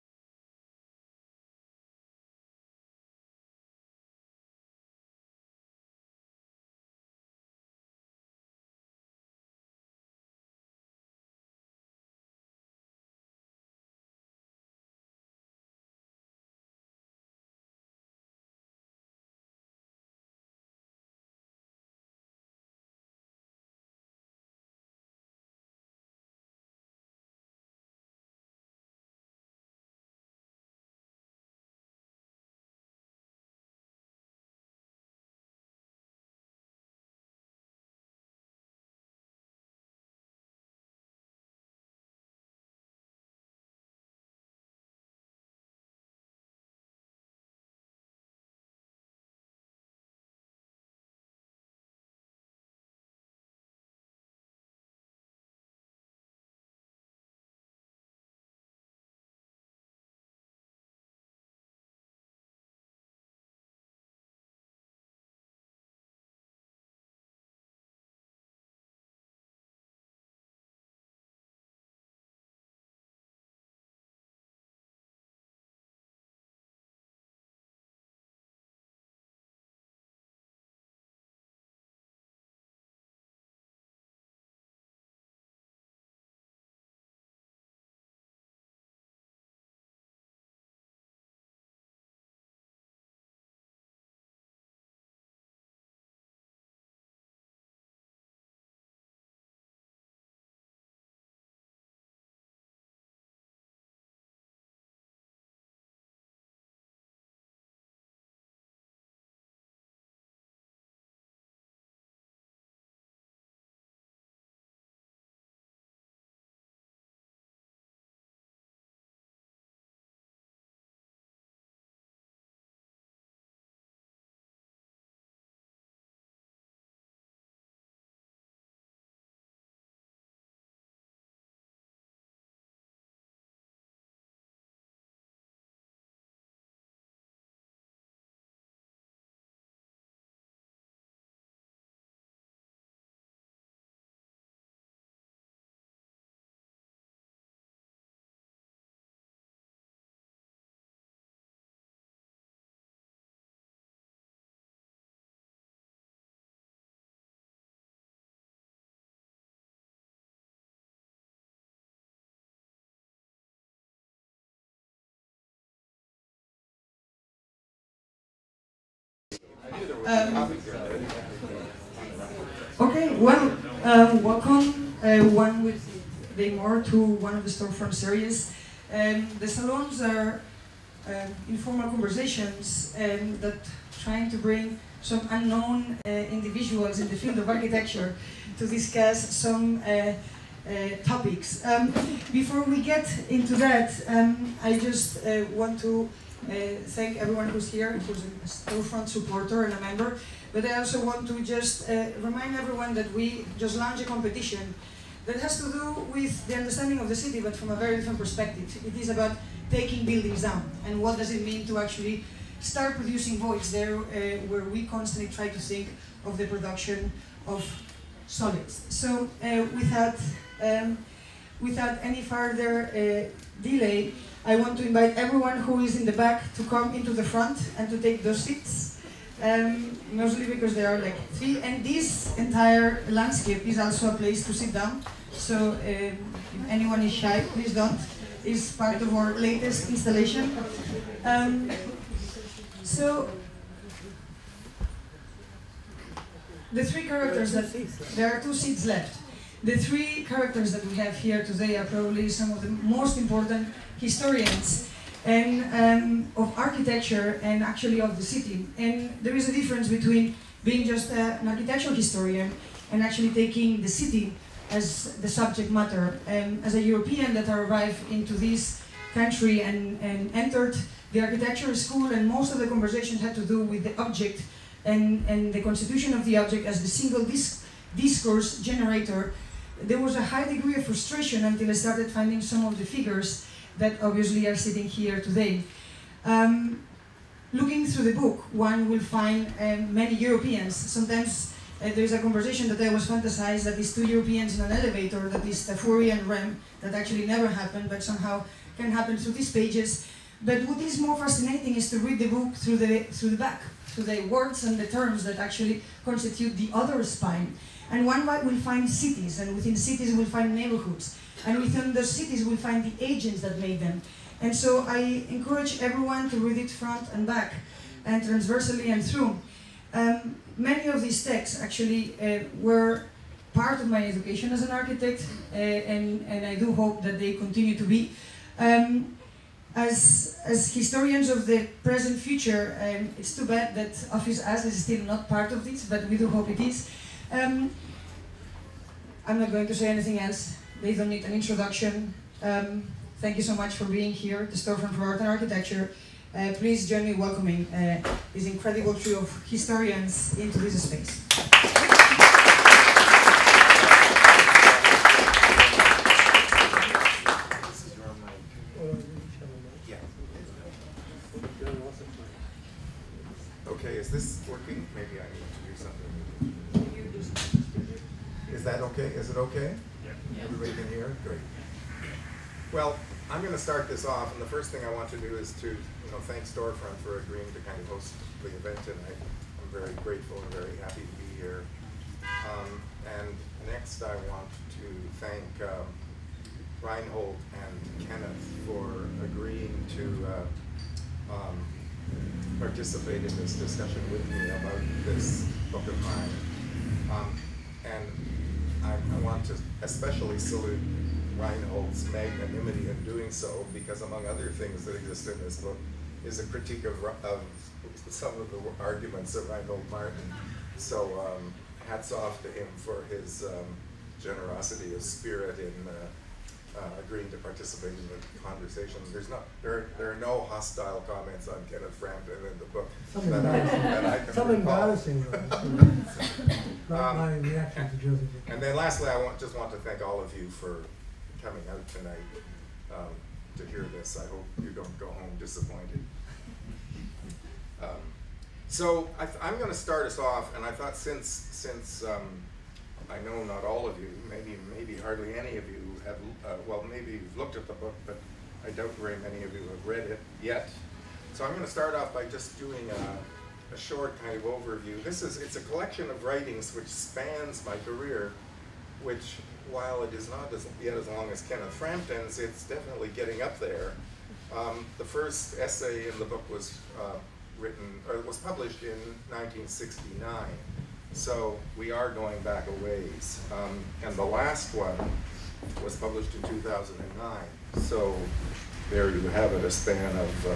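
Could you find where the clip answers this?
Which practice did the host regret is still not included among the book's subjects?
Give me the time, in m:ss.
5:34.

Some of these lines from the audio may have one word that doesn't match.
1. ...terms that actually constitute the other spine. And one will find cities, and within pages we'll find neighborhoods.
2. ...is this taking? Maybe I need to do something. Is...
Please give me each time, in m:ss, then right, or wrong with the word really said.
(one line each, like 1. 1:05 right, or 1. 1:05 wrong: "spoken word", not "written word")
1. 5:04 wrong: "cities", not "pages"
2. 6:04 wrong: "working", not "taking".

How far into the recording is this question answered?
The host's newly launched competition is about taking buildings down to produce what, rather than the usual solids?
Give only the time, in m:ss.
3:33.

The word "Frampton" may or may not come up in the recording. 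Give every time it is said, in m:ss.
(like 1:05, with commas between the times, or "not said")
7:01, 7:41.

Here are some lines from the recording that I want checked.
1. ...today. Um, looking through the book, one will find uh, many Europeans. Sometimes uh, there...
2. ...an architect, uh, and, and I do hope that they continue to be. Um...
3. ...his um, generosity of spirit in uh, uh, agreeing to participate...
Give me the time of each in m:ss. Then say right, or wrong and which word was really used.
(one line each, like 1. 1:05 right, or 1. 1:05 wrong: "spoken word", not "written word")
1. 4:45 right
2. 5:24 right
3. 6:53 right.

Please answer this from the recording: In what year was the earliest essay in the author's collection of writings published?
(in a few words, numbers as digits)
1969.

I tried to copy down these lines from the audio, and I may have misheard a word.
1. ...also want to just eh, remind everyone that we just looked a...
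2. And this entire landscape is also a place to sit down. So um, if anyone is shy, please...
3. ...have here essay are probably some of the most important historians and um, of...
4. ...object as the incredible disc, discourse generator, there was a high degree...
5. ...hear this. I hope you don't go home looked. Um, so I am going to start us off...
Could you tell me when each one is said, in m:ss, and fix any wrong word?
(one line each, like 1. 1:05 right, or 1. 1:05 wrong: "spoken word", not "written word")
1. 3:20 wrong: "launched", not "looked"
2. 3:51 right
3. 4:10 wrong: "today", not "essay"
4. 4:36 wrong: "single", not "incredible"
5. 7:13 wrong: "disappointed", not "looked".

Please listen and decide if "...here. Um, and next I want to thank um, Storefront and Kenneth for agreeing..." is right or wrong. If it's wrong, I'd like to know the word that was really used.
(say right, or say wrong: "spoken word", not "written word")
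wrong: "Reinhold", not "Storefront".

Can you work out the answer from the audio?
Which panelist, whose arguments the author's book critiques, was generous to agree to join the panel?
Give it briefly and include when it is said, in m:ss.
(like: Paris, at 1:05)
Reinhold Martin, at 6:49.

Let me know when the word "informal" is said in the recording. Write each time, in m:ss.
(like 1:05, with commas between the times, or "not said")
3:01.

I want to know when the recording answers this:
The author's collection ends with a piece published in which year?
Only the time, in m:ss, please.
7:56.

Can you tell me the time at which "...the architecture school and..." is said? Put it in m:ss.
4:31.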